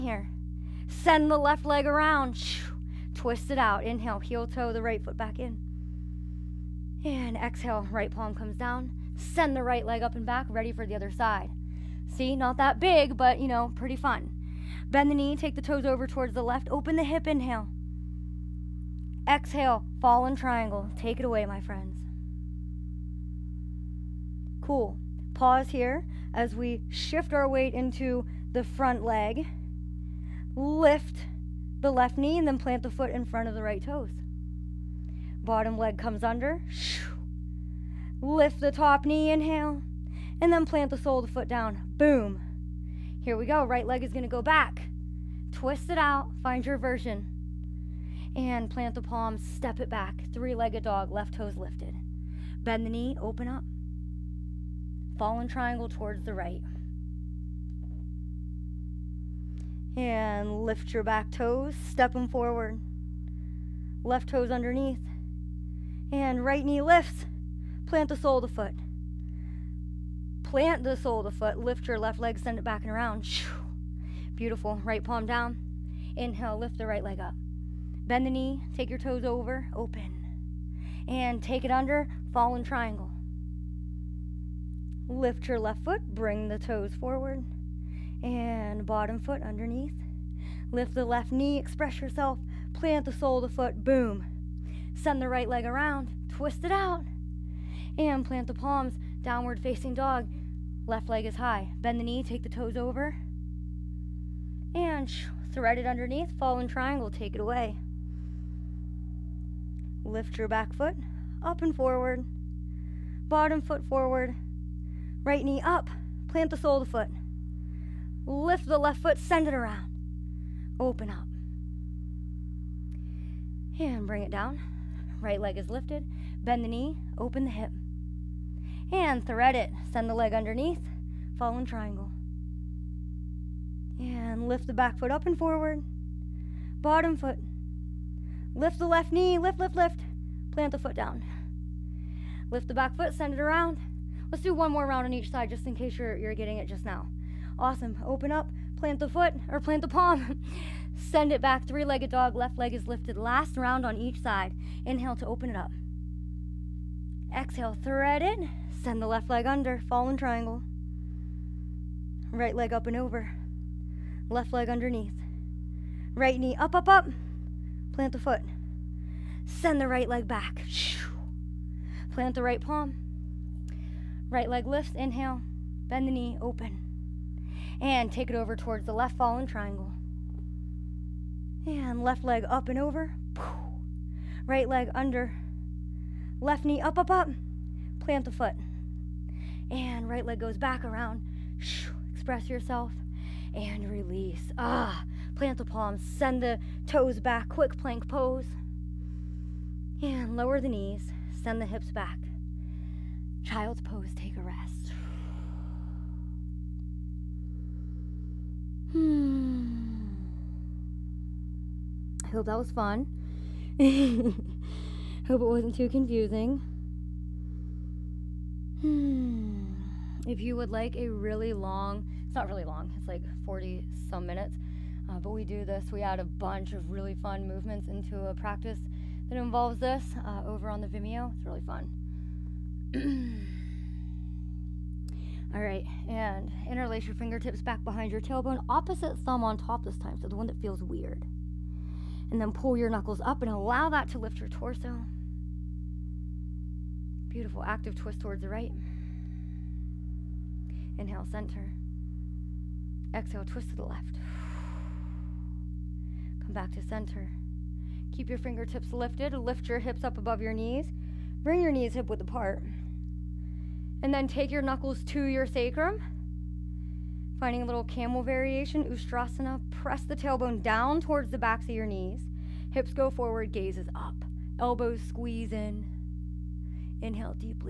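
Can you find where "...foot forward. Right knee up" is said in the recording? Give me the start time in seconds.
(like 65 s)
113 s.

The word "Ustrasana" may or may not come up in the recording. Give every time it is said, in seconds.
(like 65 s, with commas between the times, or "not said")
268 s.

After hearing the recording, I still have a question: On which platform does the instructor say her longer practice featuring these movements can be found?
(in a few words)
Vimeo.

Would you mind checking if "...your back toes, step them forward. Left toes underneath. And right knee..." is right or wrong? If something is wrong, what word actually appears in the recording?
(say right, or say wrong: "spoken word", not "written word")
right.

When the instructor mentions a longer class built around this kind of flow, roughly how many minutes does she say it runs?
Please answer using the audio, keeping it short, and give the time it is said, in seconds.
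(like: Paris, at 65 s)
40, at 223 s.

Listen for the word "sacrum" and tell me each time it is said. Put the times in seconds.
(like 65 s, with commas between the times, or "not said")
265 s.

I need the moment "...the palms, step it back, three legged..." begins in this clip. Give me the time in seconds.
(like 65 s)
48 s.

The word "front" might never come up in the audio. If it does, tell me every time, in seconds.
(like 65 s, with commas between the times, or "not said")
28 s, 33 s.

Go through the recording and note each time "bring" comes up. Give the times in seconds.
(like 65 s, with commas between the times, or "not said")
86 s, 124 s, 261 s.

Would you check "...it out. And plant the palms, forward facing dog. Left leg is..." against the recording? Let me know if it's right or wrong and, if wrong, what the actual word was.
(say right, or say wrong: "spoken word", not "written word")
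wrong: "downward", not "forward".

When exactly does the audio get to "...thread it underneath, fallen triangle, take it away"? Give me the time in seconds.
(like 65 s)
105 s.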